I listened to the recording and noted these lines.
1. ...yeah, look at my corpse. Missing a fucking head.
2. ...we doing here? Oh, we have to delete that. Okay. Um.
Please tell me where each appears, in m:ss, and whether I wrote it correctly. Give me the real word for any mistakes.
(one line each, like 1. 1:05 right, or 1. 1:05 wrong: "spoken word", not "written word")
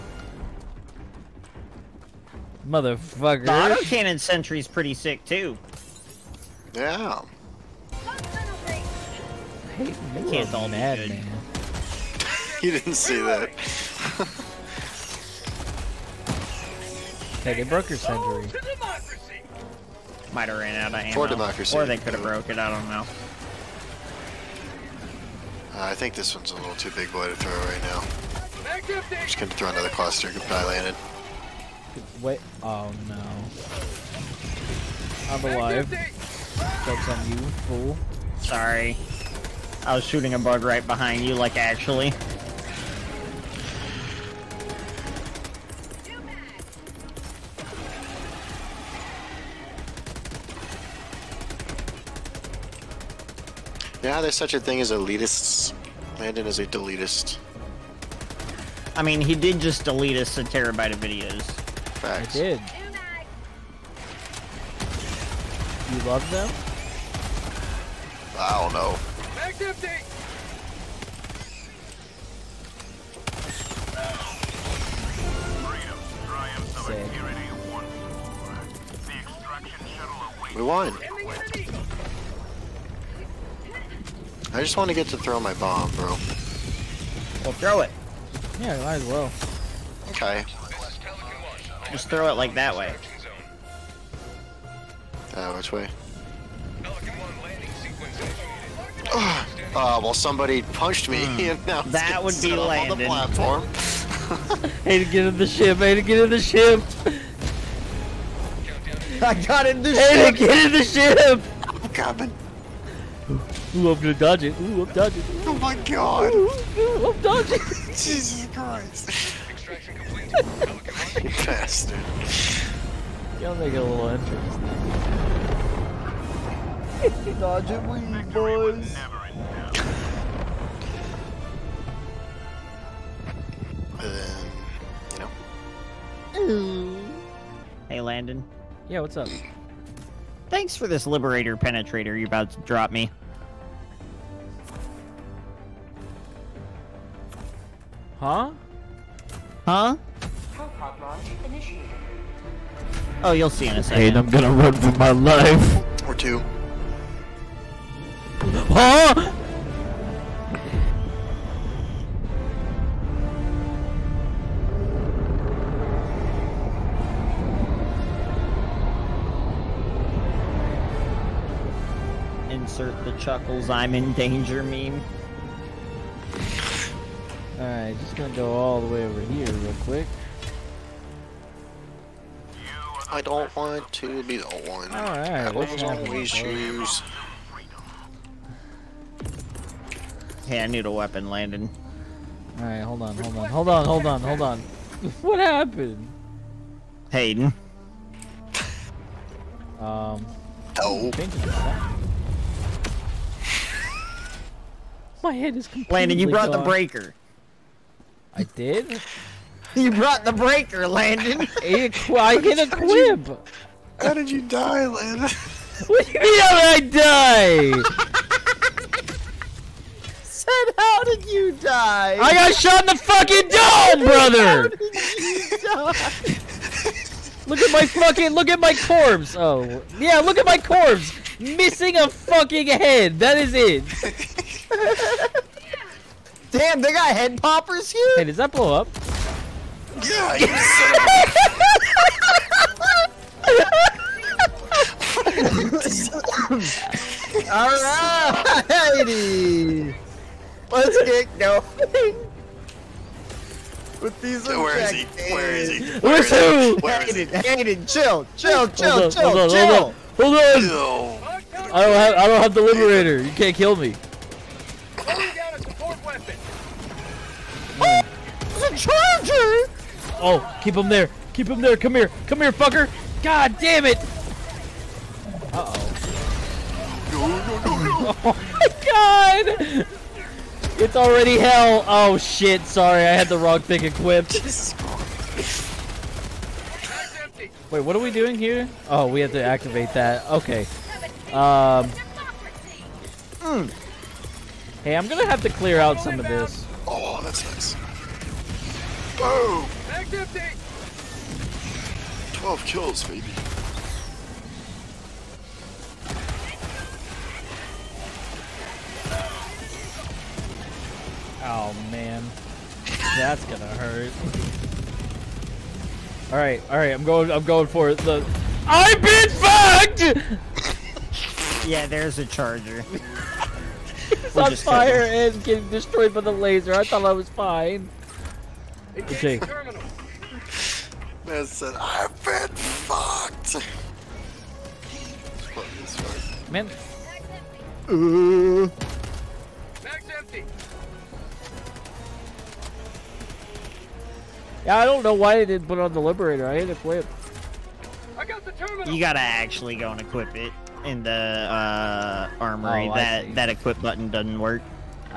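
1. 3:49 right
2. 4:48 wrong: "activate", not "delete".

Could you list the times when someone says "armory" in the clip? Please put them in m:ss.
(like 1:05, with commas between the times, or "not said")
5:52.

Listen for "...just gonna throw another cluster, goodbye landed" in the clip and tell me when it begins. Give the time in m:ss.
0:29.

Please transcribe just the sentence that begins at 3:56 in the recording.
Damn, they got head poppers here?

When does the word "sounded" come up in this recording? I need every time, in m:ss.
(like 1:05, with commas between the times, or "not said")
not said.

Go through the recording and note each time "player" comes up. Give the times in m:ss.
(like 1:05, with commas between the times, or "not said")
not said.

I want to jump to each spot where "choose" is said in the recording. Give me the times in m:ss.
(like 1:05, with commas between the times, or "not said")
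3:06.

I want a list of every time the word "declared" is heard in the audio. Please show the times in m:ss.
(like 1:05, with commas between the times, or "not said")
not said.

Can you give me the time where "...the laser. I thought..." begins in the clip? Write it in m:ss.
5:26.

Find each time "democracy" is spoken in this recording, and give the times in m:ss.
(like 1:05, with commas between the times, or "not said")
0:21.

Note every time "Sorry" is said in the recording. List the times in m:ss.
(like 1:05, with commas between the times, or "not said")
0:38, 4:42.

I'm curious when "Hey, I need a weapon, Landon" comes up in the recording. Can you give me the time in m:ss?
3:10.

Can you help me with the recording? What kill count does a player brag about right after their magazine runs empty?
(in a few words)
12.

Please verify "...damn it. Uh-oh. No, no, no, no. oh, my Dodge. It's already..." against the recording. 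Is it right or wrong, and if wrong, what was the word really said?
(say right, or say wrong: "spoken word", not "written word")
wrong: "God", not "Dodge".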